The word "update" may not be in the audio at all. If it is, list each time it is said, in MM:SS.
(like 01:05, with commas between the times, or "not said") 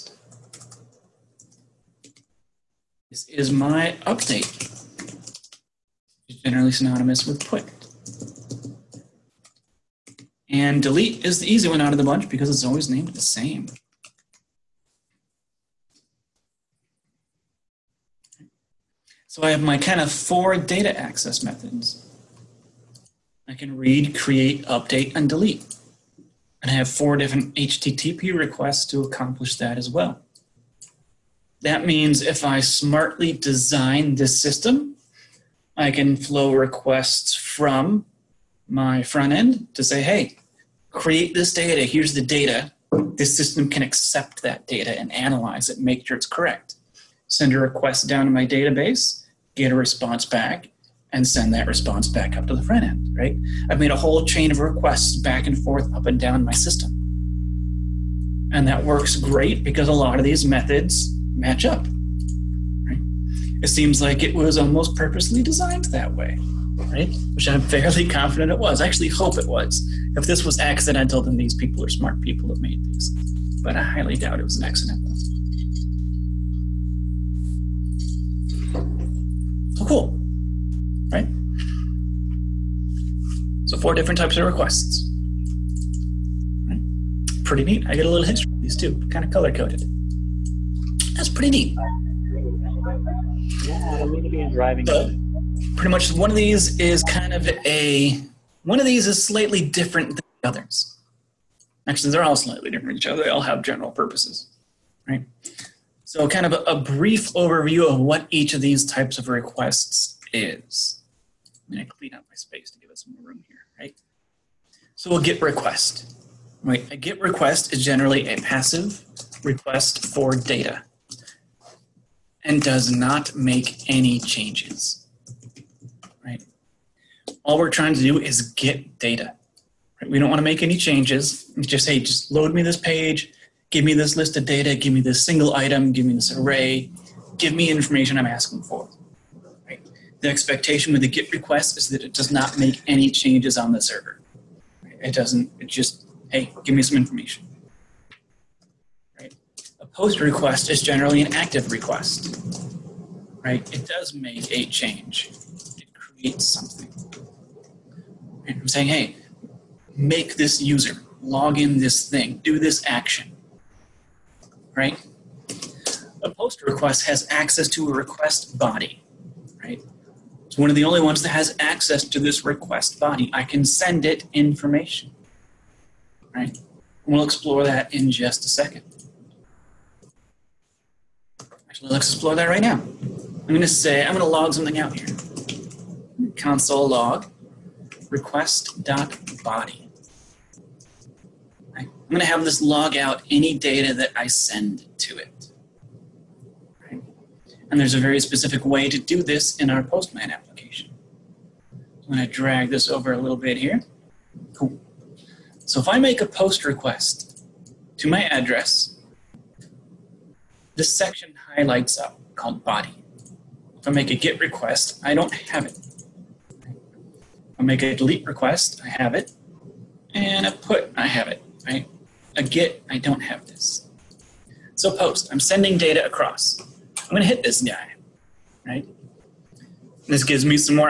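00:04, 00:24.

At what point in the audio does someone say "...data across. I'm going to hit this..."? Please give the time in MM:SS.
03:45.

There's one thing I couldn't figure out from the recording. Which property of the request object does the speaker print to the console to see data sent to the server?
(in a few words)
request.body.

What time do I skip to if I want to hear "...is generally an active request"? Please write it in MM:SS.
02:30.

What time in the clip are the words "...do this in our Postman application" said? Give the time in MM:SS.
03:18.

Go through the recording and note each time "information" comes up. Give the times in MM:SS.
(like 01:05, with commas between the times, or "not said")
02:17, 02:26, 02:54.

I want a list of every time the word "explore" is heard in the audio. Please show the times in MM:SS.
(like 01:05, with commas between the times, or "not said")
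02:57, 03:02.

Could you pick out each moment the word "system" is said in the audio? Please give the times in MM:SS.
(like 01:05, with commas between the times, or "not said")
00:34, 00:43, 00:56.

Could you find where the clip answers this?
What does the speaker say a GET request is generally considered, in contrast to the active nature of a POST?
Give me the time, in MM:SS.
01:58.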